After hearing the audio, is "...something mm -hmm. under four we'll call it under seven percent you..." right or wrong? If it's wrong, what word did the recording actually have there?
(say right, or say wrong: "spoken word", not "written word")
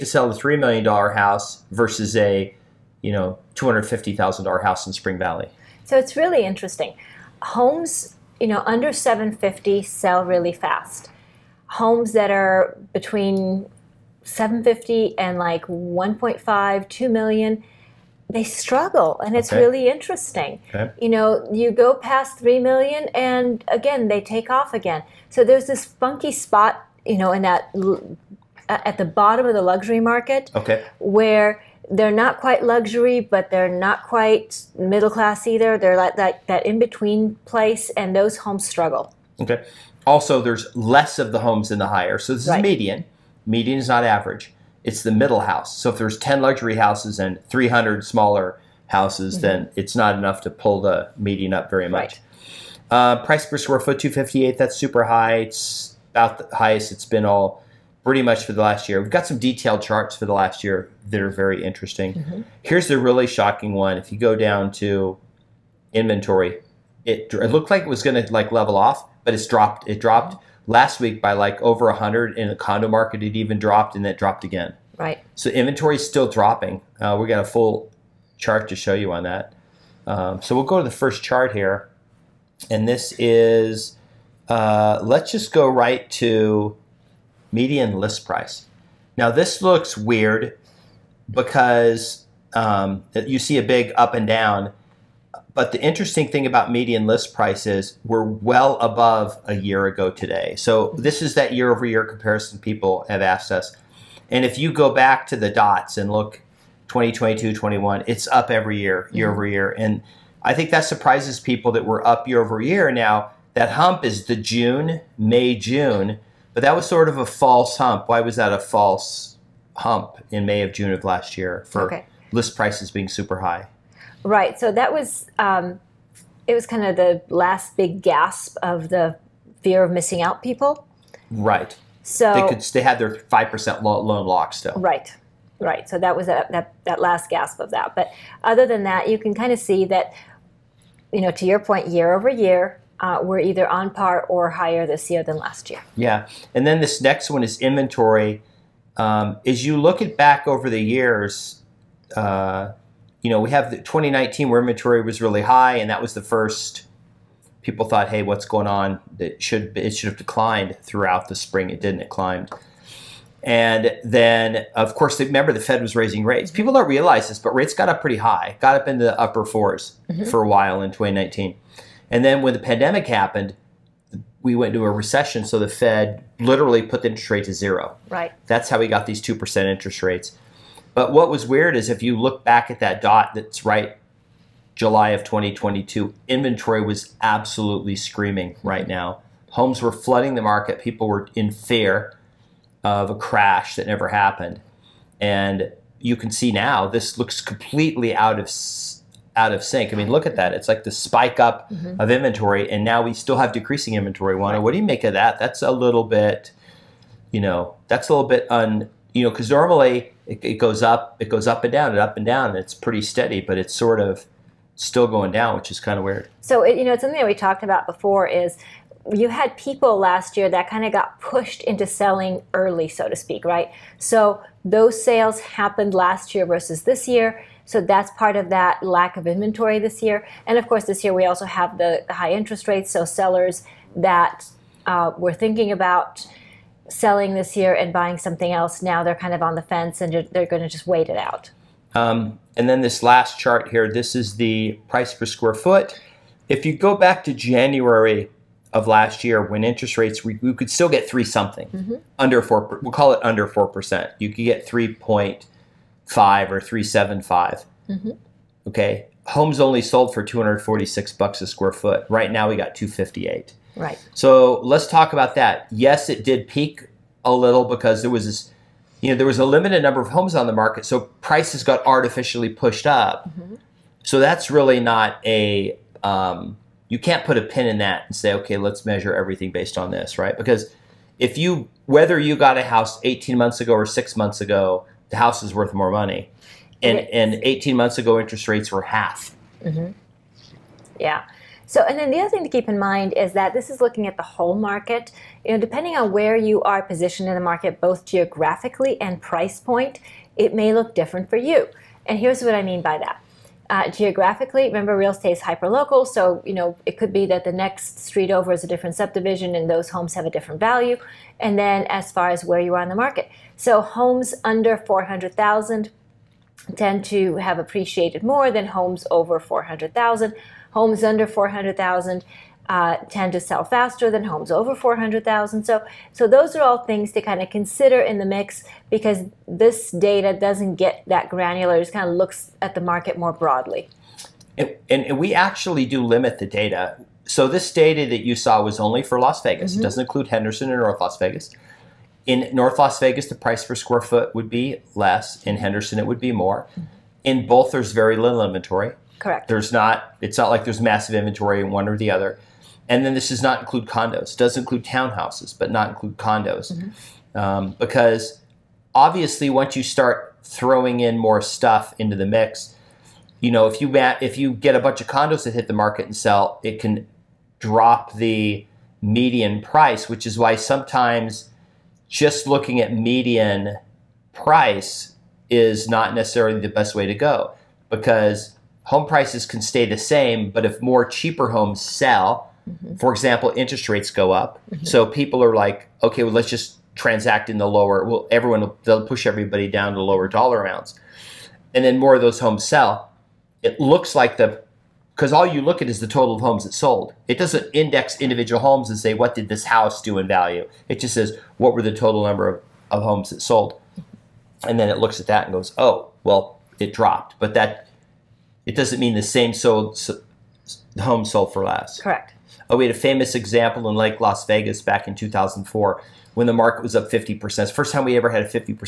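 wrong: "four", not "seven".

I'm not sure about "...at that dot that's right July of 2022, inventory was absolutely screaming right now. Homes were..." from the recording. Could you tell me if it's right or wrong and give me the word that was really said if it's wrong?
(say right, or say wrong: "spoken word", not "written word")
right.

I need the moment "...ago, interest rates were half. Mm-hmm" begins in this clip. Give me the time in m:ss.
4:47.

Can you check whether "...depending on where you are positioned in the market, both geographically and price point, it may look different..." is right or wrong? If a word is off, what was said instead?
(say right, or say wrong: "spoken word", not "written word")
right.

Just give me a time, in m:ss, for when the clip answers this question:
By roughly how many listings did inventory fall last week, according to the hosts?
1:11.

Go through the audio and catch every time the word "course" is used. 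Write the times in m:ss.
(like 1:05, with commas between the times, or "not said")
2:44, 3:50.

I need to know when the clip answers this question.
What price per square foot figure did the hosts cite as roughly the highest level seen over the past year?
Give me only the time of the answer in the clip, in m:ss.
0:53.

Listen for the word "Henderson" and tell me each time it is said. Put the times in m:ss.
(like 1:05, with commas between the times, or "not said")
5:40, 5:45.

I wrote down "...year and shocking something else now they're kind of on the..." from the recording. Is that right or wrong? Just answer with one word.
wrong.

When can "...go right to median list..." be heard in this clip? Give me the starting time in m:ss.
1:25.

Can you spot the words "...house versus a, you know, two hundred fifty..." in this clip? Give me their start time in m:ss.
0:01.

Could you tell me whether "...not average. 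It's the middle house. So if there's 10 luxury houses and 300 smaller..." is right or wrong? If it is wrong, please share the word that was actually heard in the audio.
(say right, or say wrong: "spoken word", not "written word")
right.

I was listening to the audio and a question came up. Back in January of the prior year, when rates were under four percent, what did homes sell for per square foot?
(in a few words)
$246.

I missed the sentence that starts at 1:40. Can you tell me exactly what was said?
So this is that year over year comparison people have asked us.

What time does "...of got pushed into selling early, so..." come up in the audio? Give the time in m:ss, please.
3:40.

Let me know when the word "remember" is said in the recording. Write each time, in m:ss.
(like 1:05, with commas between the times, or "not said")
2:45, 5:04.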